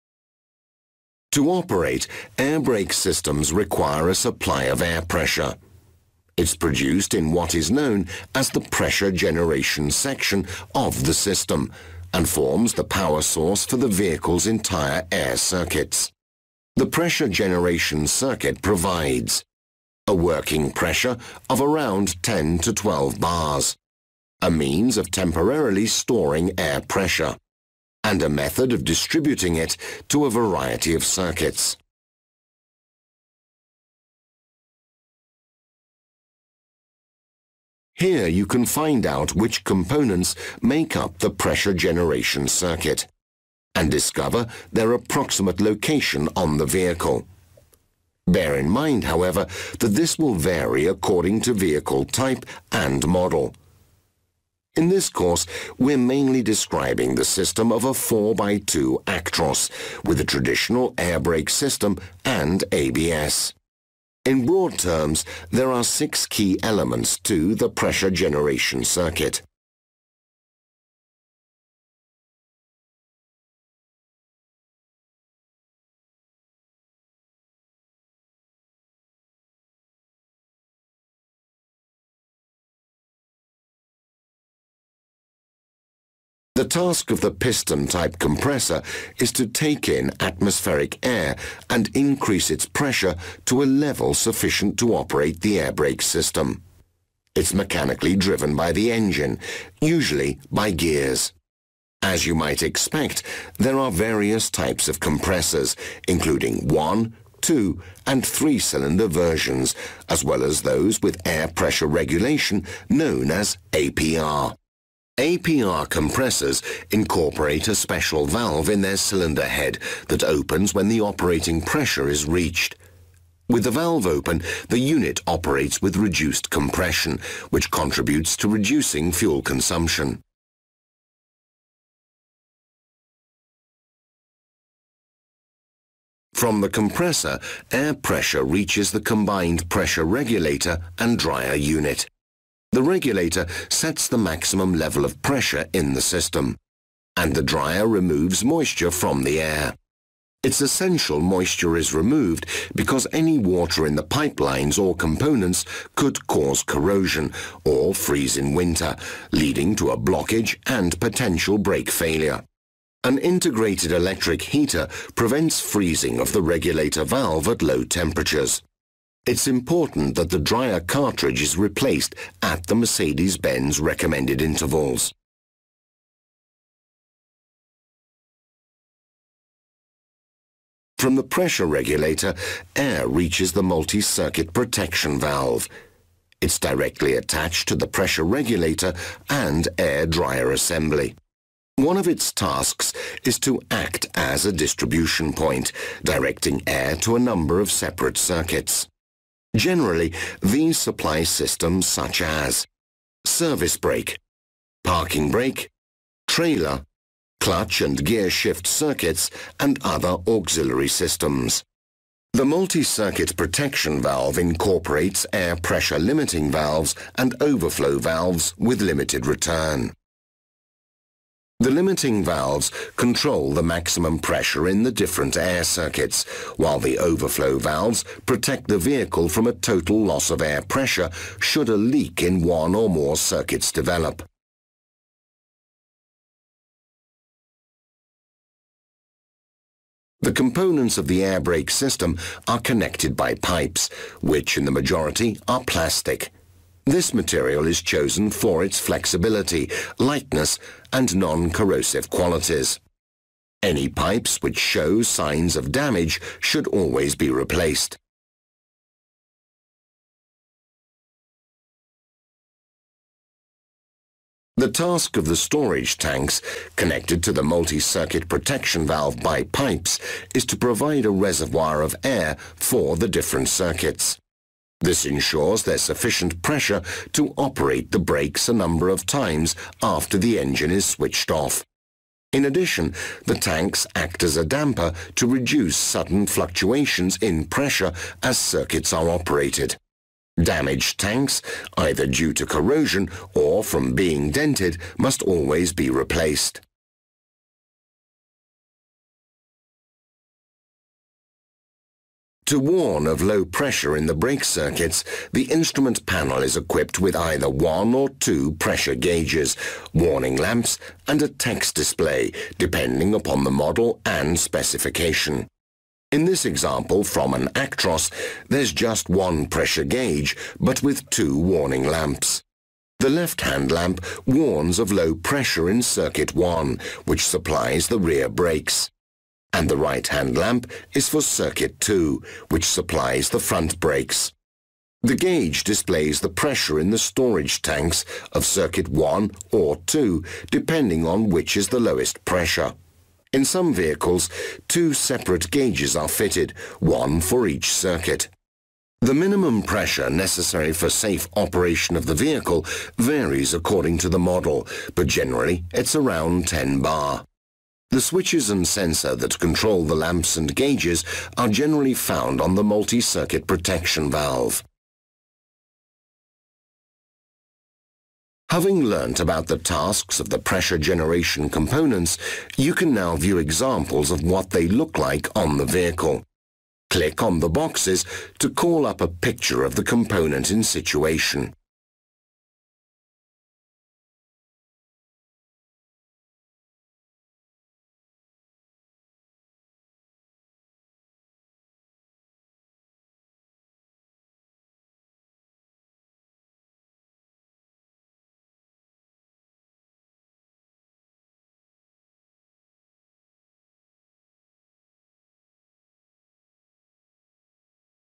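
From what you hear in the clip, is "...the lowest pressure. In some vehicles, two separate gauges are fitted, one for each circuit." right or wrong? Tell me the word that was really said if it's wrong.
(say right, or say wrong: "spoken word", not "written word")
right.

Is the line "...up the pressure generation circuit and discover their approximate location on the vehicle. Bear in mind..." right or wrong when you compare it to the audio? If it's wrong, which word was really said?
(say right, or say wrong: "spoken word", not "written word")
right.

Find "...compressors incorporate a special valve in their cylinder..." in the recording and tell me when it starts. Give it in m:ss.
1:55.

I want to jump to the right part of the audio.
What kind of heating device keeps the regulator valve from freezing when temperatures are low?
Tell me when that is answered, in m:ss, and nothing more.
2:43.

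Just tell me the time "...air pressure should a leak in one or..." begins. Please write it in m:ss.
3:50.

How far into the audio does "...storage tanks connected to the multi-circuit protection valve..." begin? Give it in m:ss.
4:25.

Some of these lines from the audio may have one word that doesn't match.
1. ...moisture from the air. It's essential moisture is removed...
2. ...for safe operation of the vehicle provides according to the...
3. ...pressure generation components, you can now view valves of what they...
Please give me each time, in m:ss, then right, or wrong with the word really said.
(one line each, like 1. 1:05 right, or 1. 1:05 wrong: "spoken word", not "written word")
1. 2:28 right
2. 5:50 wrong: "varies", not "provides"
3. 6:10 wrong: "examples", not "valves".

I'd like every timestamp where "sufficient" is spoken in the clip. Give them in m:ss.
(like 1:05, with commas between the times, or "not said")
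1:34, 4:35.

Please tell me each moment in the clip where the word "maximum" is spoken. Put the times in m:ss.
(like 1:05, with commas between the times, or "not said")
2:24, 3:43.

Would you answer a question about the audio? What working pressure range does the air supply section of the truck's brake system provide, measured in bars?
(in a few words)
10 to 12 bars.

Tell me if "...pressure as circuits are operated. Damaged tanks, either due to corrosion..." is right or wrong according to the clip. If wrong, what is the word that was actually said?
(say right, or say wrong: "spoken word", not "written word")
right.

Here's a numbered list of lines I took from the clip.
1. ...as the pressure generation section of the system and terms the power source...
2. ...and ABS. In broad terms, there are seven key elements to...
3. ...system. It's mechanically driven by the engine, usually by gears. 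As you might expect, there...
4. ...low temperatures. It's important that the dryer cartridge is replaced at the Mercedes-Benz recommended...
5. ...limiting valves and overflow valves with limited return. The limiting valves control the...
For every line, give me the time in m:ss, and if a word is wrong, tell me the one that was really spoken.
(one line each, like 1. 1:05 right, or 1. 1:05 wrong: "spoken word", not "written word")
1. 0:08 wrong: "forms", not "terms"
2. 1:02 wrong: "six", not "seven"
3. 1:36 right
4. 2:47 right
5. 3:35 right.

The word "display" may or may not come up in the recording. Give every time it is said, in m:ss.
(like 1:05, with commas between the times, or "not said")
5:11, 5:35.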